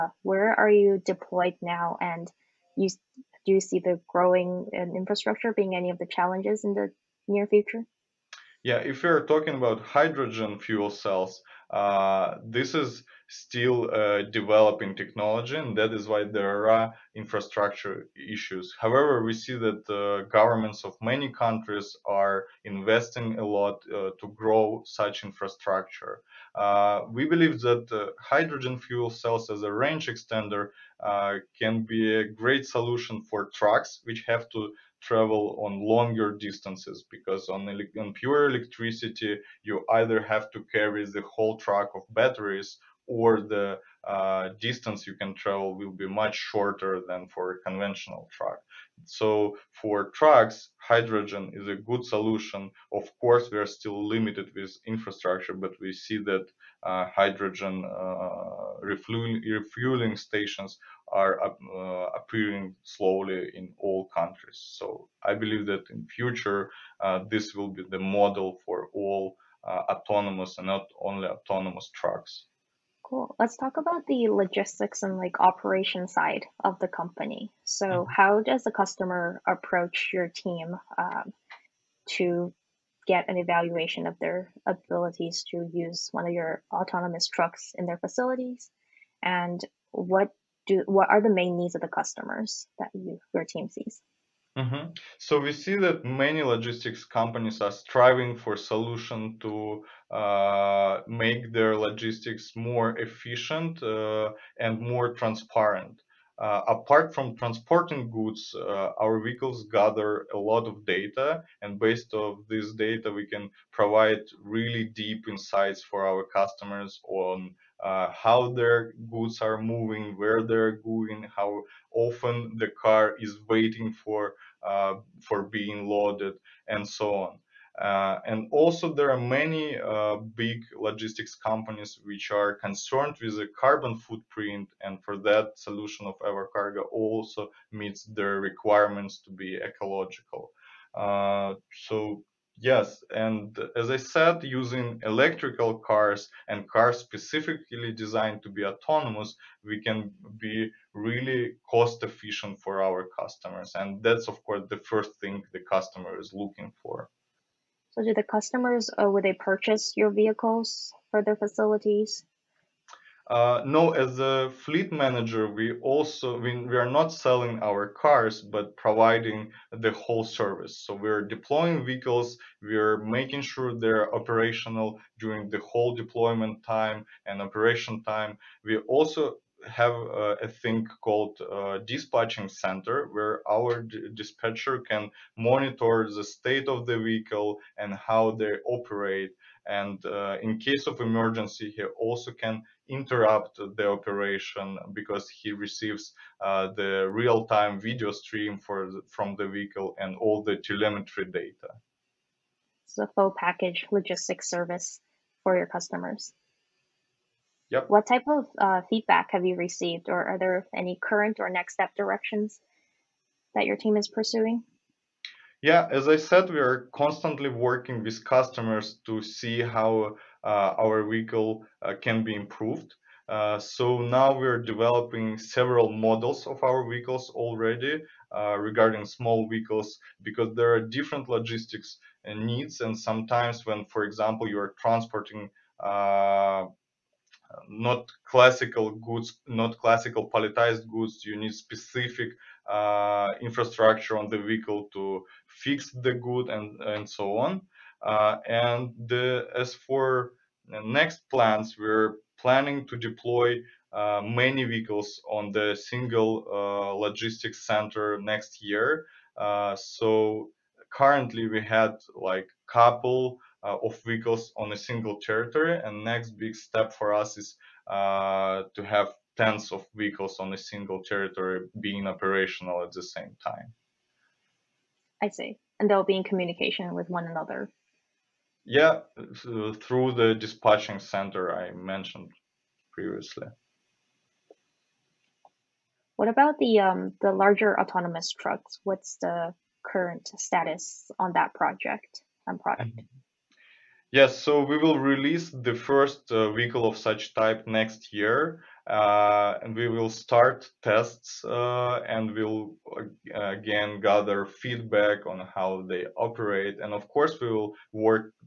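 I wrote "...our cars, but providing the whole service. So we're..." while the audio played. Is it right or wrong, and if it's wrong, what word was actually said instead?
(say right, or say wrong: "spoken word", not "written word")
right.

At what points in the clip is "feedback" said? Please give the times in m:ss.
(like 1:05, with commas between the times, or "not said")
3:28, 5:04.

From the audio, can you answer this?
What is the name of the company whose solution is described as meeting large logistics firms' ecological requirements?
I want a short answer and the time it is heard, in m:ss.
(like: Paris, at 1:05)
Evocargo, at 2:16.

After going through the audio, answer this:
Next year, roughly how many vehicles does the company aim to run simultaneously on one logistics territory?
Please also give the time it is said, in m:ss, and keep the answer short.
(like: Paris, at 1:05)
Tens of vehicles, at 4:29.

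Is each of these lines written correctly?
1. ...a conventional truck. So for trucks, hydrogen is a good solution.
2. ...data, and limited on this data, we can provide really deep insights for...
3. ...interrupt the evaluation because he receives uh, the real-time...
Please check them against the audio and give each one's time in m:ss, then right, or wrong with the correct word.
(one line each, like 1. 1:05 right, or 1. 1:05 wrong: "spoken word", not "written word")
1. 0:47 right
2. 1:50 wrong: "based", not "limited"
3. 3:12 wrong: "operation", not "evaluation".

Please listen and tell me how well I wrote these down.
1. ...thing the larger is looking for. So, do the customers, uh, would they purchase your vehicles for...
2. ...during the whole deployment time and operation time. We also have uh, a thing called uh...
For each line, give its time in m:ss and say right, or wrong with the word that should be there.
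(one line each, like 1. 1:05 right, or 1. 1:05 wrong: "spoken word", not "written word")
1. 2:35 wrong: "customer", not "larger"
2. 2:55 right.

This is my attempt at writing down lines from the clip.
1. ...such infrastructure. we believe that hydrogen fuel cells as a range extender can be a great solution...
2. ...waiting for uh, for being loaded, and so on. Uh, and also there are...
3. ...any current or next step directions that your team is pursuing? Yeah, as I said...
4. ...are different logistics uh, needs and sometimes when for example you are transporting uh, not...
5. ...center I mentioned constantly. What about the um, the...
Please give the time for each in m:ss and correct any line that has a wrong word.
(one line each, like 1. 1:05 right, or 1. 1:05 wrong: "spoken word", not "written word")
1. 0:24 right
2. 2:03 right
3. 3:30 right
4. 3:50 right
5. 4:40 wrong: "previously", not "constantly".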